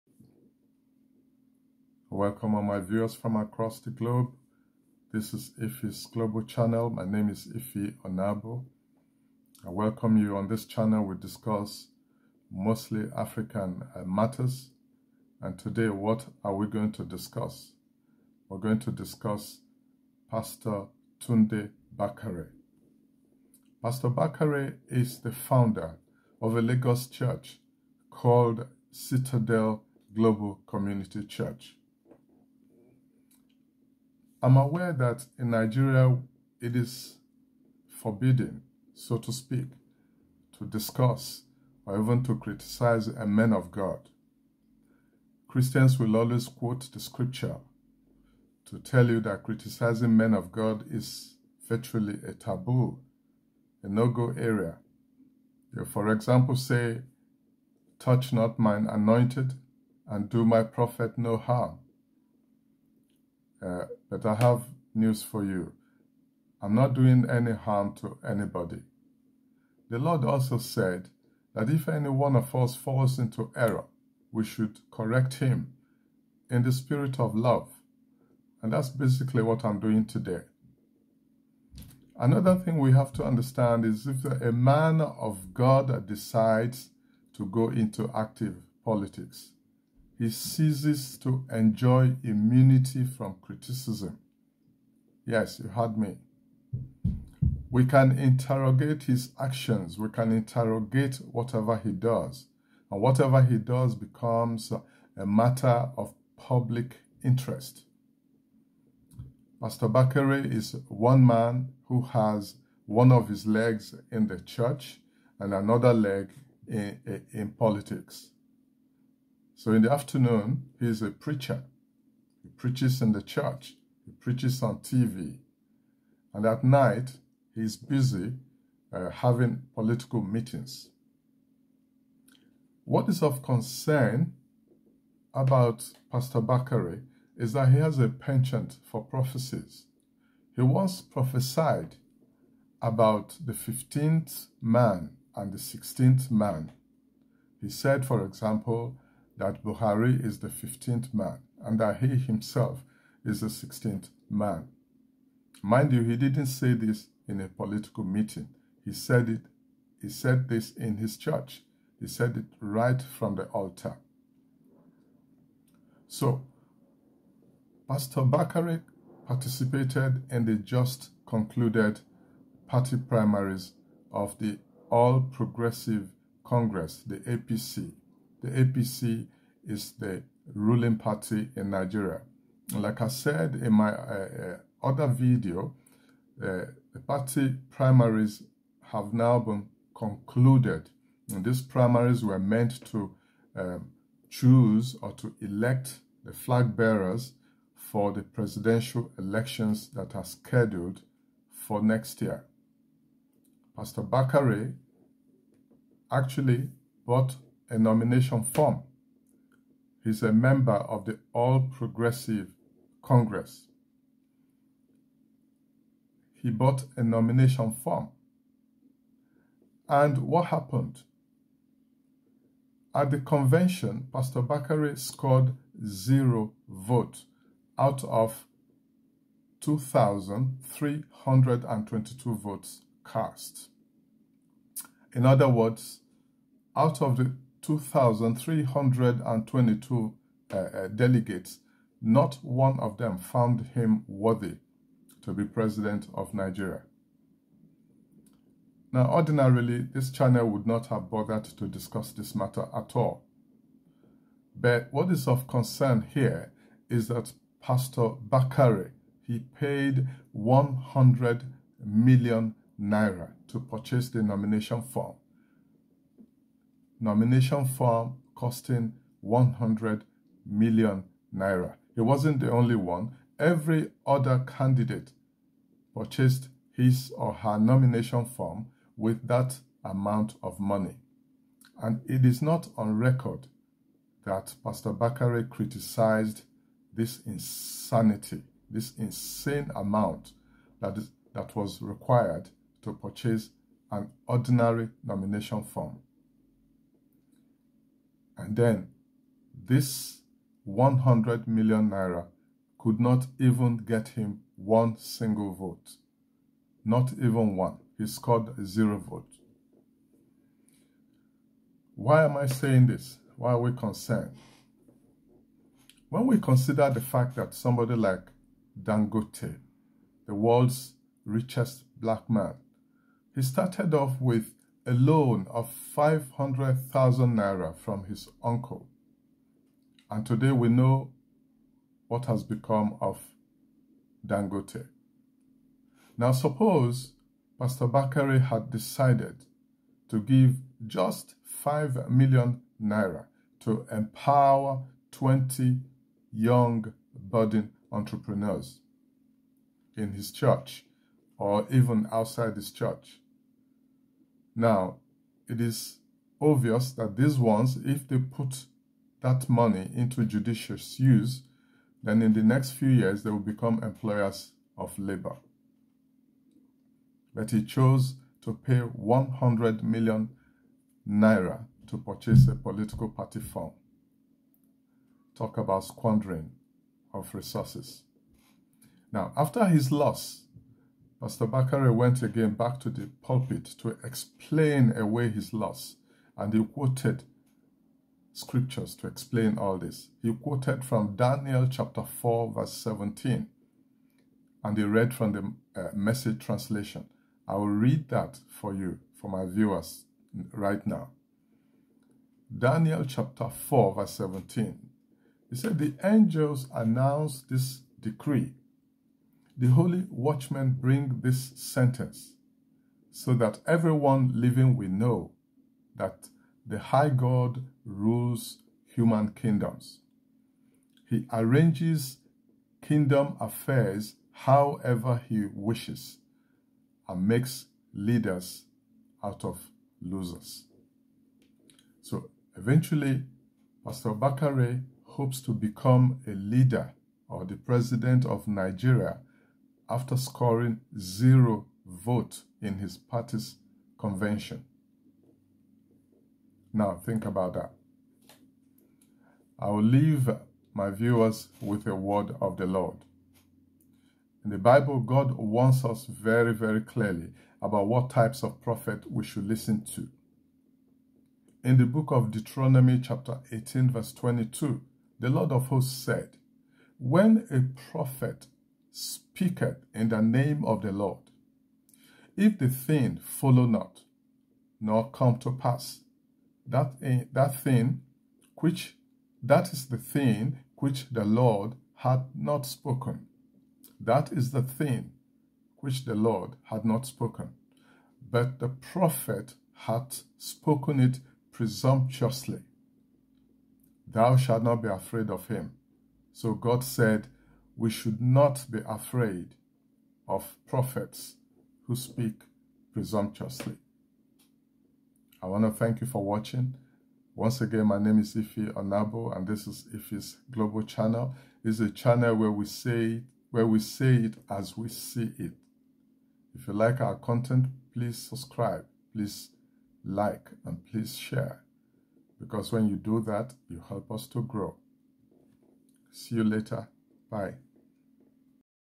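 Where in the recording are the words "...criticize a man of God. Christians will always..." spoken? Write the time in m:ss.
0:42.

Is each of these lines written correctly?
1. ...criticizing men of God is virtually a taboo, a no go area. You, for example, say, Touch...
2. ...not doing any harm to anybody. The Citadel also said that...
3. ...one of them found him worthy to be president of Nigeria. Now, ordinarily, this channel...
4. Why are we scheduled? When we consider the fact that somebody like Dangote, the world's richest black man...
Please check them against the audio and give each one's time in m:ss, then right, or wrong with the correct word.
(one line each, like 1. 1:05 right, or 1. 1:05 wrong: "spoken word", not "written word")
1. 0:49 right
2. 1:06 wrong: "Lord", not "Citadel"
3. 4:02 right
4. 5:13 wrong: "concerned", not "scheduled".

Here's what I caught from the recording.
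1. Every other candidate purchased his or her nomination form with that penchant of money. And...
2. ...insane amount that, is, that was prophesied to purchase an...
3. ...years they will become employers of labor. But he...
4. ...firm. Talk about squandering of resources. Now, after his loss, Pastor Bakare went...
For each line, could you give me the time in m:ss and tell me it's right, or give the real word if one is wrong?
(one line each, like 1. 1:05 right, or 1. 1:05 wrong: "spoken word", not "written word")
1. 4:33 wrong: "amount", not "penchant"
2. 4:48 wrong: "required", not "prophesied"
3. 6:02 right
4. 6:13 right.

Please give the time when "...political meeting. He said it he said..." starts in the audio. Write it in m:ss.
2:37.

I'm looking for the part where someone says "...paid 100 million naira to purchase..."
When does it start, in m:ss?
4:19.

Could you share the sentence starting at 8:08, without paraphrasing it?
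But the prophet hath spoken it presumptuously.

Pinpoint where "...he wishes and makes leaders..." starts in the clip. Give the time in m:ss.
7:05.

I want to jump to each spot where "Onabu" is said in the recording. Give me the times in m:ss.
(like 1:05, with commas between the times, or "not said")
0:08, 8:28.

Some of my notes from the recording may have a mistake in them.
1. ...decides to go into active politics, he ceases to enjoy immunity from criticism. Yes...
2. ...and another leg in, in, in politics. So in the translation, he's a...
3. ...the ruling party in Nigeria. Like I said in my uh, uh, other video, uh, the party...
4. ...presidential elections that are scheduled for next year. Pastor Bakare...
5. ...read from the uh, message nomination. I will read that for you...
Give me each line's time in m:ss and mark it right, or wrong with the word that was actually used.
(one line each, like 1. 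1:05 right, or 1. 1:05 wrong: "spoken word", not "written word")
1. 1:26 right
2. 1:55 wrong: "afternoon", not "translation"
3. 2:59 right
4. 3:18 right
5. 6:34 wrong: "translation", not "nomination".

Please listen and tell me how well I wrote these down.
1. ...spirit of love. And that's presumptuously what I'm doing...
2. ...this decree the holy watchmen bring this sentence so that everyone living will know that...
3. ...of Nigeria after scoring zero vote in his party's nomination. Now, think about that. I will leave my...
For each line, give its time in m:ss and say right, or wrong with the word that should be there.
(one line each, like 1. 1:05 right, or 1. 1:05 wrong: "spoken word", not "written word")
1. 1:16 wrong: "basically", not "presumptuously"
2. 6:47 right
3. 7:18 wrong: "convention", not "nomination".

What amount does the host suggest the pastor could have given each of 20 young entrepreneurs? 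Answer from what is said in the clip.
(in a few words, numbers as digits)
5 million naira.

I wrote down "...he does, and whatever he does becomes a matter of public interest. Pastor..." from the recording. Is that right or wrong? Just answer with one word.
right.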